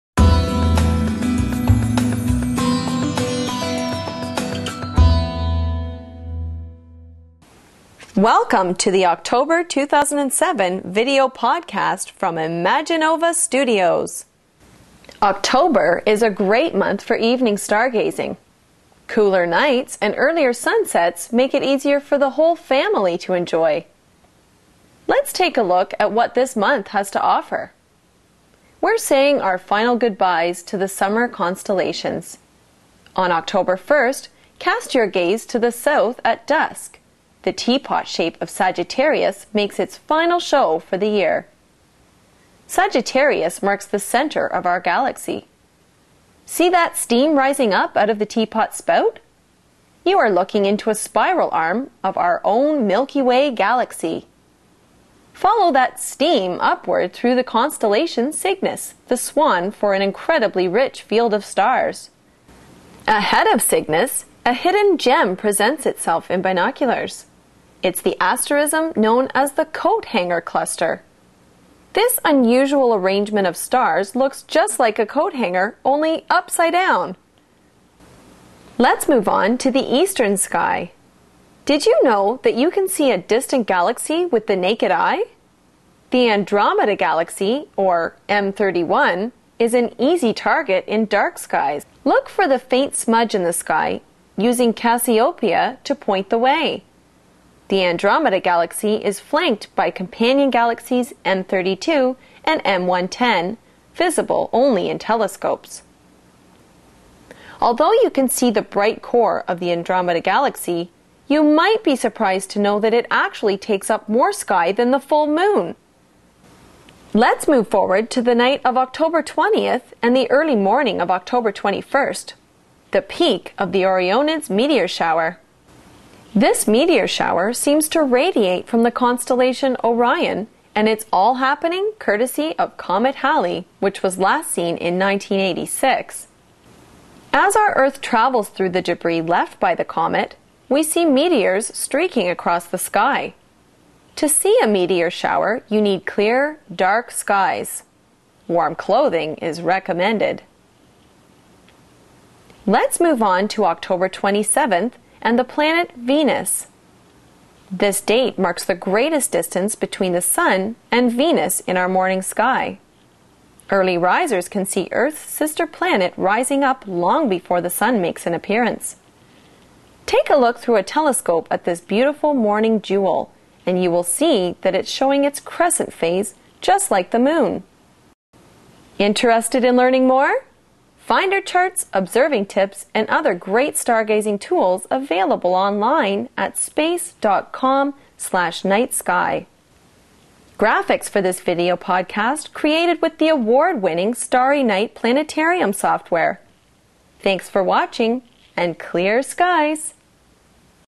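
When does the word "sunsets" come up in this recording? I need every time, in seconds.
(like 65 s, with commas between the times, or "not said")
20 s.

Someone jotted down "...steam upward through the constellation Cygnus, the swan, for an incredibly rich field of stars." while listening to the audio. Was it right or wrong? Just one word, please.
right.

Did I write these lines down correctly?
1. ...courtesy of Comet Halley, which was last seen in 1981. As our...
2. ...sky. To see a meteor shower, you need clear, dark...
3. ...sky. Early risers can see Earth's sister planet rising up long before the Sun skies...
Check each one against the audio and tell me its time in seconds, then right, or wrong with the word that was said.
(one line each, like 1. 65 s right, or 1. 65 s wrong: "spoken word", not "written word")
1. 131 s wrong: "1986", not "1981"
2. 142 s right
3. 162 s wrong: "makes", not "skies".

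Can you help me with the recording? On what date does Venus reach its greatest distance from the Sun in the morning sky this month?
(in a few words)
October 27th.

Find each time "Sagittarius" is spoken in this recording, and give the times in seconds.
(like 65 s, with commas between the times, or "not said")
38 s, 42 s.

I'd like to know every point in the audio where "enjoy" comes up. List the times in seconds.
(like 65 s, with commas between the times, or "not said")
23 s.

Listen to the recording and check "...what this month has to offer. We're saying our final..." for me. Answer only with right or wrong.
right.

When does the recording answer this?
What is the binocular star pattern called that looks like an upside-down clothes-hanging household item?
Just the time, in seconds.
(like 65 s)
69 s.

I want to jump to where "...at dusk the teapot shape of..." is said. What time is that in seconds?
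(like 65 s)
36 s.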